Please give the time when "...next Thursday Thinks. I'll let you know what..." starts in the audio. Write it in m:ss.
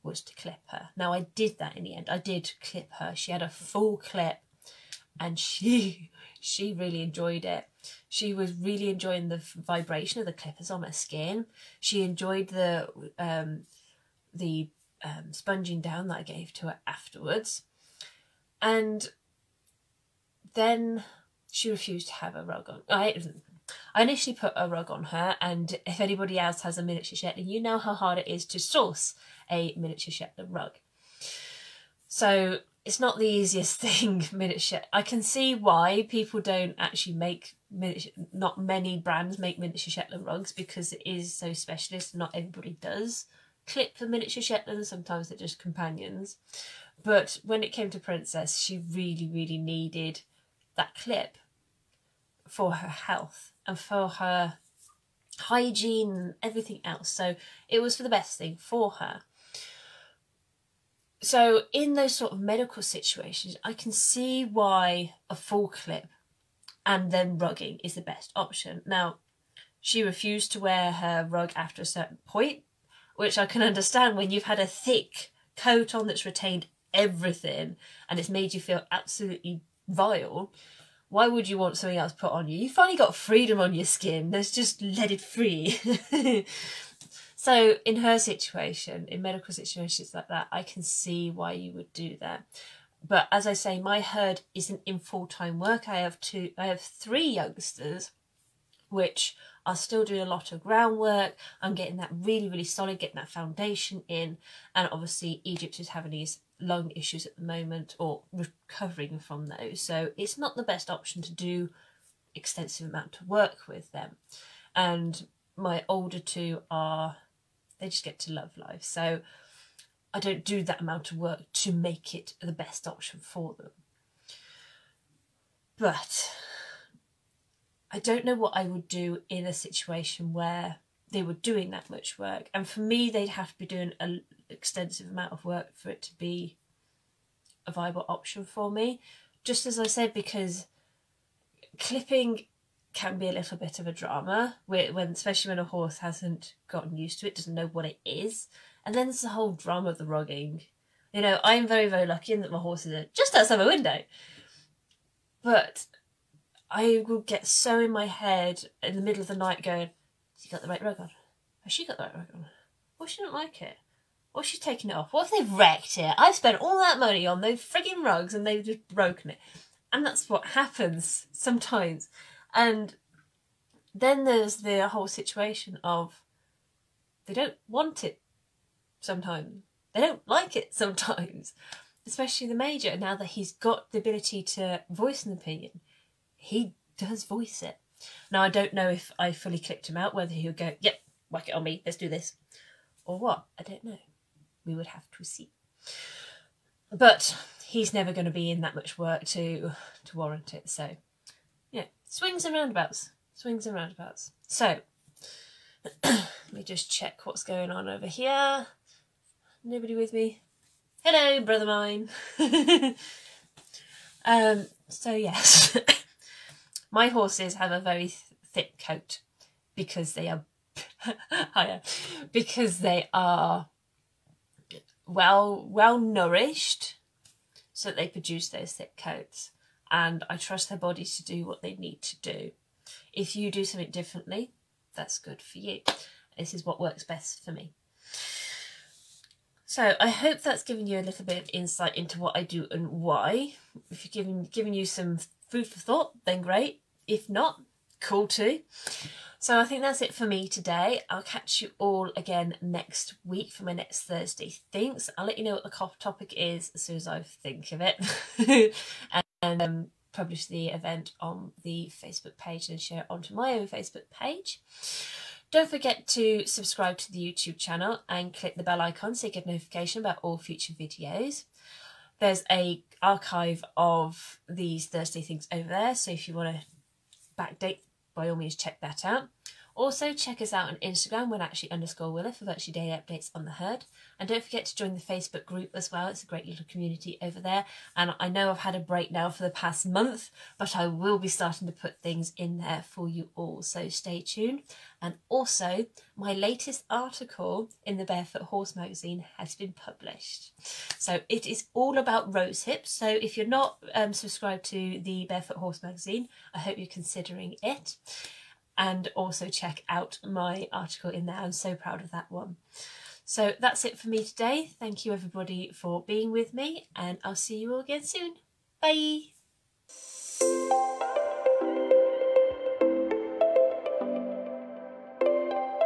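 4:13.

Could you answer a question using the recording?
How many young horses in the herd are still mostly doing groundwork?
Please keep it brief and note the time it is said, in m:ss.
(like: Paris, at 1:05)
3, at 1:36.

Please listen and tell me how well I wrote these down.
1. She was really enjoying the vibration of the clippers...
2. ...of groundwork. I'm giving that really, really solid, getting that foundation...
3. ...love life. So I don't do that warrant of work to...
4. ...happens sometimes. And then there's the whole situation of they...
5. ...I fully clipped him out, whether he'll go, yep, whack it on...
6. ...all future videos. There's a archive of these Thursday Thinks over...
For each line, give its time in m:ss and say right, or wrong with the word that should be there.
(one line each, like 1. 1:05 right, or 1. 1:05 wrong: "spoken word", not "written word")
1. 0:08 right
2. 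1:40 wrong: "getting", not "giving"
3. 1:58 wrong: "amount", not "warrant"
4. 2:50 right
5. 3:09 right
6. 4:30 right.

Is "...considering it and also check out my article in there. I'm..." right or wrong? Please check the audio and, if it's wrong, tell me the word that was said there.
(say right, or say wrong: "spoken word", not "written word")
right.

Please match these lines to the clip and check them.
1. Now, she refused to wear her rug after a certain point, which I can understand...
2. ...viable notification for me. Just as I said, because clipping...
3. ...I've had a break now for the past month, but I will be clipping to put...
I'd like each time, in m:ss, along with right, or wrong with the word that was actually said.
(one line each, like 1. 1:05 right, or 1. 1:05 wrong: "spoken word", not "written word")
1. 1:08 right
2. 2:17 wrong: "option", not "notification"
3. 4:48 wrong: "starting", not "clipping".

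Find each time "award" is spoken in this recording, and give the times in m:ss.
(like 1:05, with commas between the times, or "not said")
not said.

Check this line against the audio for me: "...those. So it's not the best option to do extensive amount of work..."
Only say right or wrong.
right.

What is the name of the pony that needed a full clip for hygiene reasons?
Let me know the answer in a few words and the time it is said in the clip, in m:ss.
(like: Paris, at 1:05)
Princess, at 0:47.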